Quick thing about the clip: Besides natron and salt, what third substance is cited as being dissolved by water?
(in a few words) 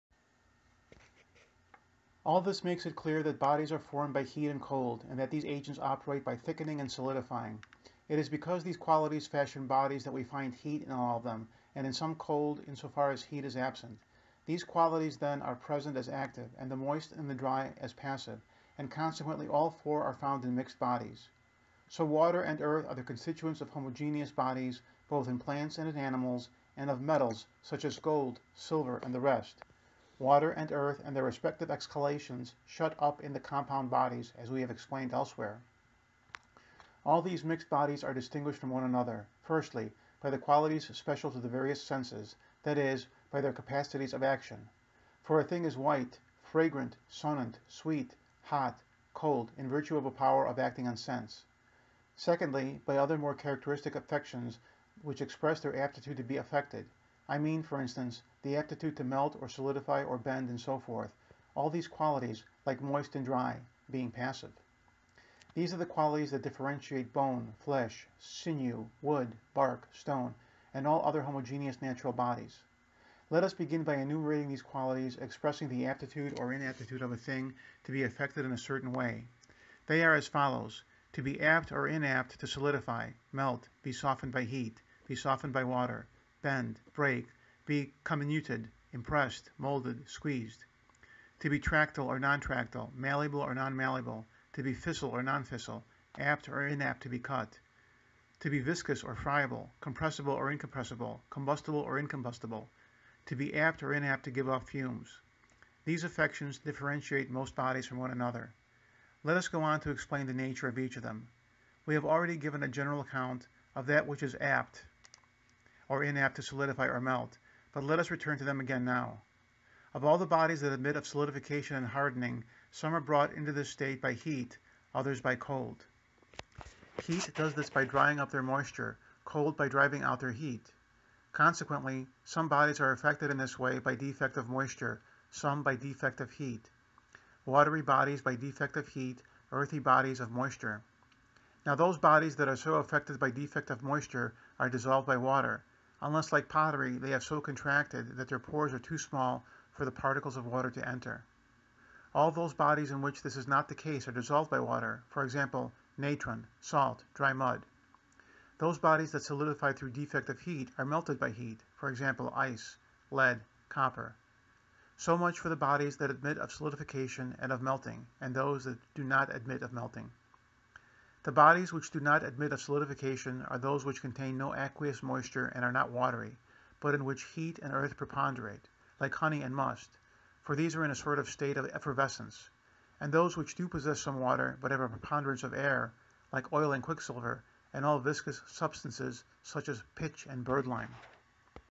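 Dry mud.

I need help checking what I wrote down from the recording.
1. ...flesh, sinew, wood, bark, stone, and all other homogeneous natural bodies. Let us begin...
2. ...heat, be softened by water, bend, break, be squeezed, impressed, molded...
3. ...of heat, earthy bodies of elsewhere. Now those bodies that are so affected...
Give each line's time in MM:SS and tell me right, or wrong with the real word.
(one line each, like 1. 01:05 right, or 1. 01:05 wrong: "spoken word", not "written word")
1. 01:07 right
2. 01:24 wrong: "comminuted", not "squeezed"
3. 02:18 wrong: "moisture", not "elsewhere".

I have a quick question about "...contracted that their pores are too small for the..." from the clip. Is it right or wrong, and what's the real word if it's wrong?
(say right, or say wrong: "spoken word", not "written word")
right.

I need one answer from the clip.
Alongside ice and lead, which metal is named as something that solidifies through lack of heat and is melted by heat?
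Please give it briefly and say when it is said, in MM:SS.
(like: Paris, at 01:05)
Copper, at 02:43.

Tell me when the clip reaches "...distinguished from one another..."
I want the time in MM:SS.
00:38.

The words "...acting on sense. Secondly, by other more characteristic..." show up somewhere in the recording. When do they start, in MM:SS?
00:50.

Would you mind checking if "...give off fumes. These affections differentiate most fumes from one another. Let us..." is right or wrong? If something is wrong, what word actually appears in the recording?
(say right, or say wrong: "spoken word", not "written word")
wrong: "bodies", not "fumes".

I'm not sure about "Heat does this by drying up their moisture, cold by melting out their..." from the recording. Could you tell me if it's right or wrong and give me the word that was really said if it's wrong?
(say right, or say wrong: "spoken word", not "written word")
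wrong: "driving", not "melting".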